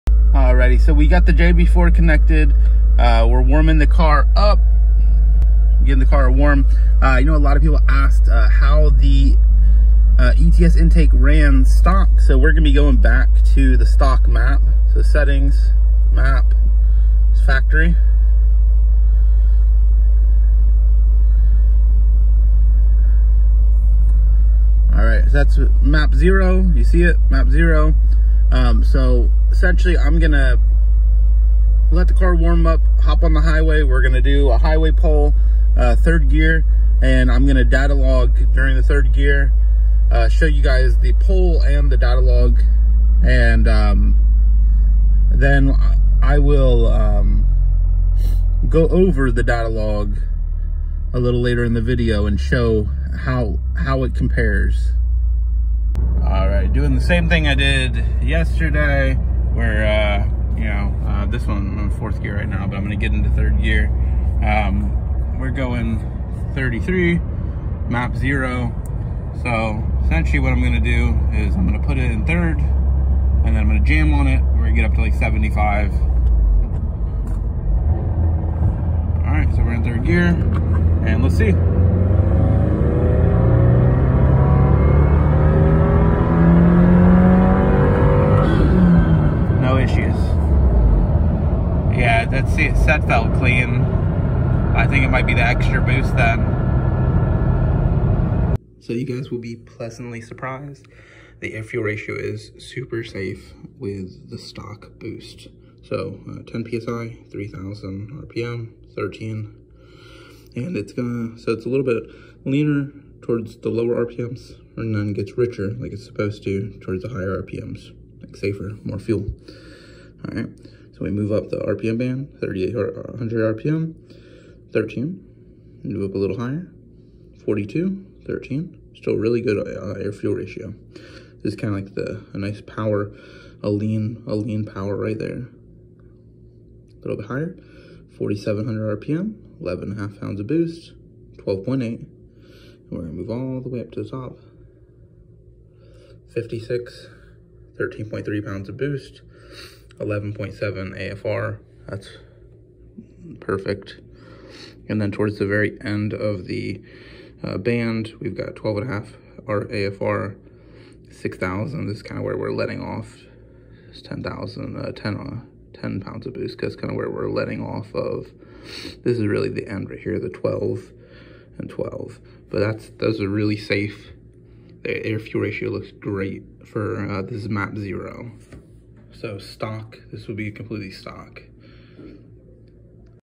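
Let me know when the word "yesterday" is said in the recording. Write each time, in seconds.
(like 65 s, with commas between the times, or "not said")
58 s.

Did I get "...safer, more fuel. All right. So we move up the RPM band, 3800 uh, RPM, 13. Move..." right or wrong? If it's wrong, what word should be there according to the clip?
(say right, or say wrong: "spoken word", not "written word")
right.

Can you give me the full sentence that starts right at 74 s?
We're going to get up to like 75.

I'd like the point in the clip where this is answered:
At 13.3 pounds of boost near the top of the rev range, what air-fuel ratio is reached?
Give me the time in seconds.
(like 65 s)
150 s.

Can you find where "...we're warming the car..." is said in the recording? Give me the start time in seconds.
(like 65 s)
3 s.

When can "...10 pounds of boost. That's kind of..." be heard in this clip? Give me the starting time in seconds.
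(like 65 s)
165 s.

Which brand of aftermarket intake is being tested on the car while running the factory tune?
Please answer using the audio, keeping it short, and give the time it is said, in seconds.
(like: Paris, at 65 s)
ETS, at 10 s.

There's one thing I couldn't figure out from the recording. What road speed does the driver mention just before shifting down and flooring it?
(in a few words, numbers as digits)
33.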